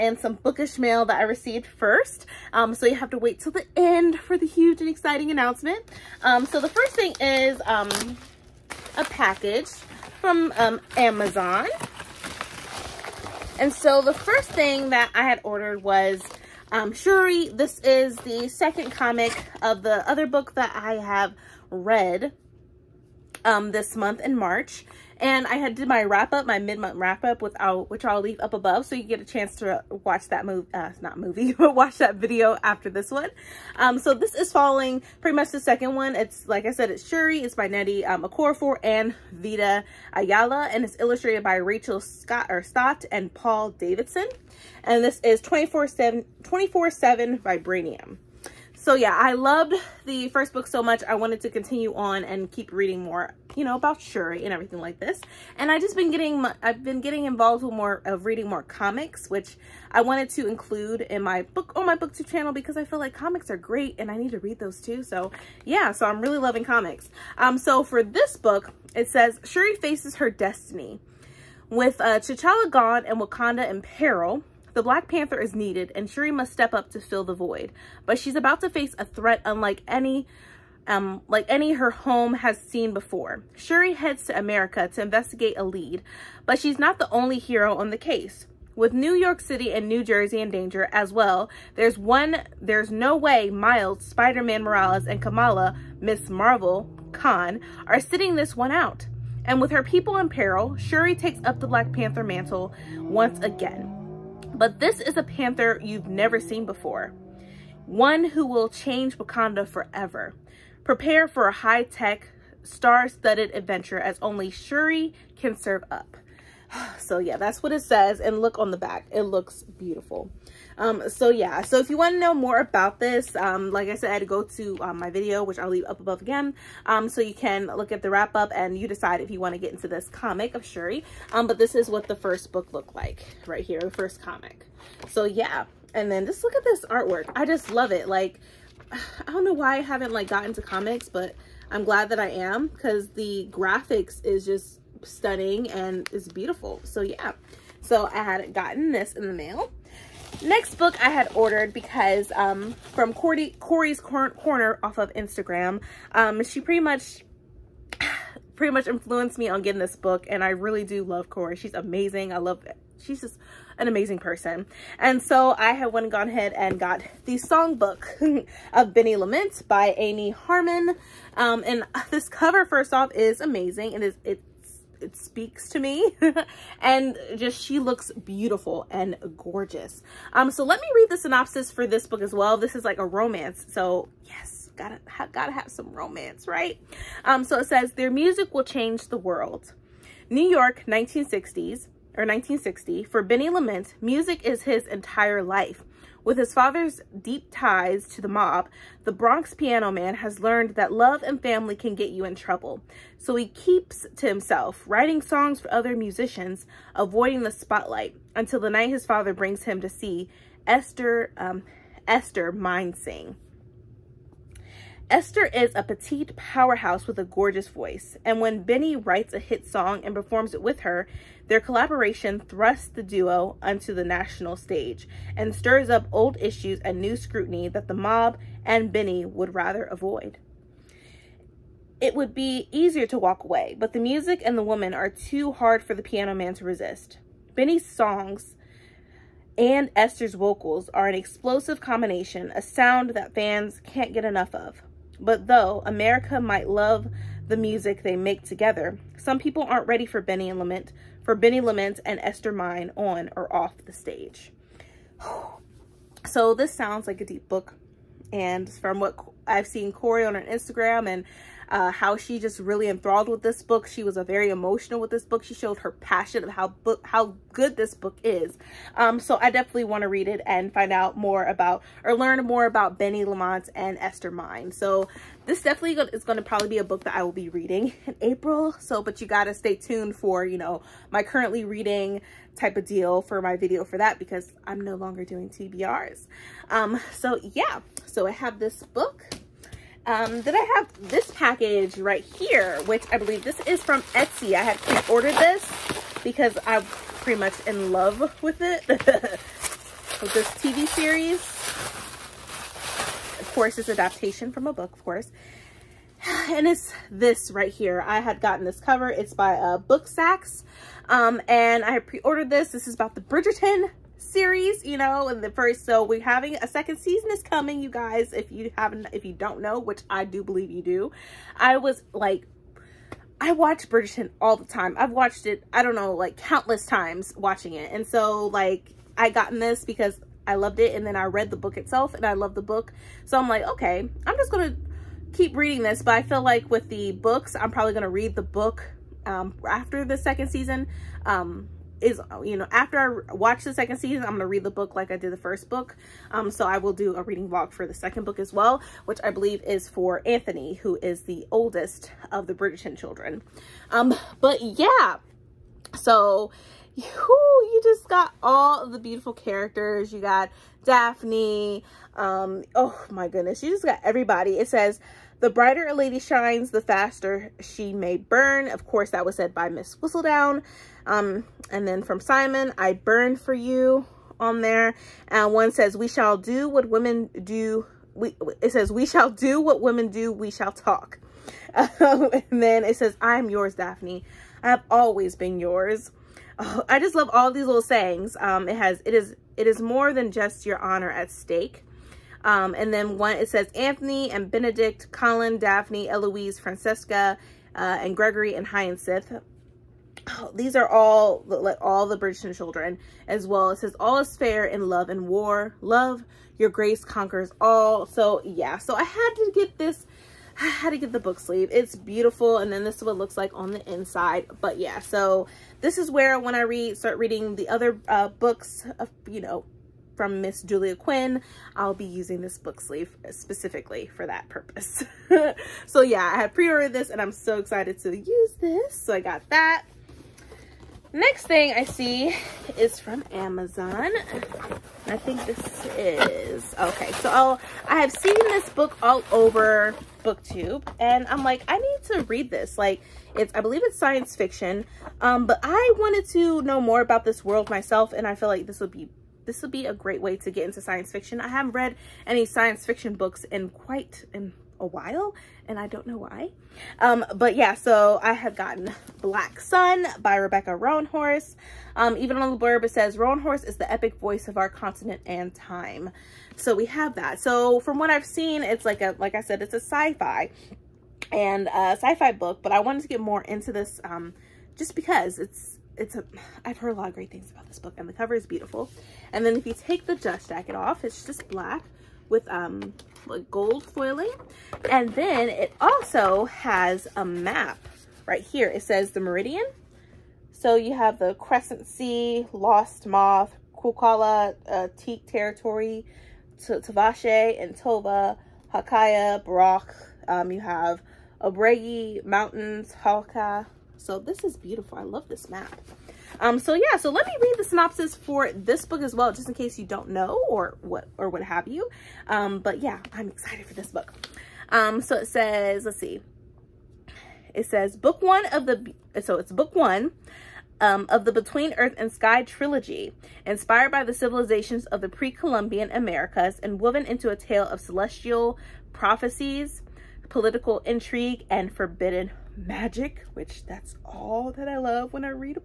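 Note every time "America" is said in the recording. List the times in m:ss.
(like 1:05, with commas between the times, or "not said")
1:24, 4:05, 8:45.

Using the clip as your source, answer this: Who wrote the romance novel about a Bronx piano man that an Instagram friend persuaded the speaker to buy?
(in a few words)
Amy Harmon.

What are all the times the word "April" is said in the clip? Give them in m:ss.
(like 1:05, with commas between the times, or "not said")
4:38.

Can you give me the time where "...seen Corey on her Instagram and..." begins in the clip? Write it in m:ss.
4:19.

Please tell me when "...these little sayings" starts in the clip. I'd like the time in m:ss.
6:27.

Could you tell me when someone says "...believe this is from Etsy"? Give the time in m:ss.
4:53.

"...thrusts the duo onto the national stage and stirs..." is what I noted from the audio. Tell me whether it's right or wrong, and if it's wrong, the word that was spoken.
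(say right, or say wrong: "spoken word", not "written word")
right.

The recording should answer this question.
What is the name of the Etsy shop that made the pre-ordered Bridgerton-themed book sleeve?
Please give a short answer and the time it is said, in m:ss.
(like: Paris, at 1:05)
Book Sacks, at 5:09.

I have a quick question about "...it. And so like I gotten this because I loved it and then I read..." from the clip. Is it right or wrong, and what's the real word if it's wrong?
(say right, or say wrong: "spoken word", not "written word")
right.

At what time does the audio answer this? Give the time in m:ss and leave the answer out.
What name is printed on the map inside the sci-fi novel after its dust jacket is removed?
8:09.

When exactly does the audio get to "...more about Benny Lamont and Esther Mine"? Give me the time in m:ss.
4:32.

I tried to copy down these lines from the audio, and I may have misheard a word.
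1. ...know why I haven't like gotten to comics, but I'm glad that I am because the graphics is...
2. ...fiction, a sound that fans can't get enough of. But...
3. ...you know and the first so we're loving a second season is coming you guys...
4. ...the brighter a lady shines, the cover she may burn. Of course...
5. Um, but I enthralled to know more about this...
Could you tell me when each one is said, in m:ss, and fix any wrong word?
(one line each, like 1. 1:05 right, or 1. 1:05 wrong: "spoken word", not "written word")
1. 2:19 right
2. 4:01 wrong: "combination", not "fiction"
3. 5:14 wrong: "having", not "loving"
4. 6:05 wrong: "faster", not "cover"
5. 7:25 wrong: "wanted", not "enthralled".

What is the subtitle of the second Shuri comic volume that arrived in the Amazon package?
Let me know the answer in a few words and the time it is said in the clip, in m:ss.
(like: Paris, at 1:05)
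24-7 Vibranium, at 0:46.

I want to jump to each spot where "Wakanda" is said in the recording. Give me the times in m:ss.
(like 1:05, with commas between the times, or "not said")
1:13, 1:49.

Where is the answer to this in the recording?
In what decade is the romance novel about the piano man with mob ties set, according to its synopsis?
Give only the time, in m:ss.
3:10.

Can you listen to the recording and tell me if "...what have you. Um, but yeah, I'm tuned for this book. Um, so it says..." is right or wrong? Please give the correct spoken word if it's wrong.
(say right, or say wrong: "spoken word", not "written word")
wrong: "excited", not "tuned".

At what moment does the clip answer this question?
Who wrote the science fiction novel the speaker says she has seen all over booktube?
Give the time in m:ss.
7:40.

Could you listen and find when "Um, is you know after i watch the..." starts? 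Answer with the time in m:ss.
5:41.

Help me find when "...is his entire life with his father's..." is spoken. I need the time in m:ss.
3:14.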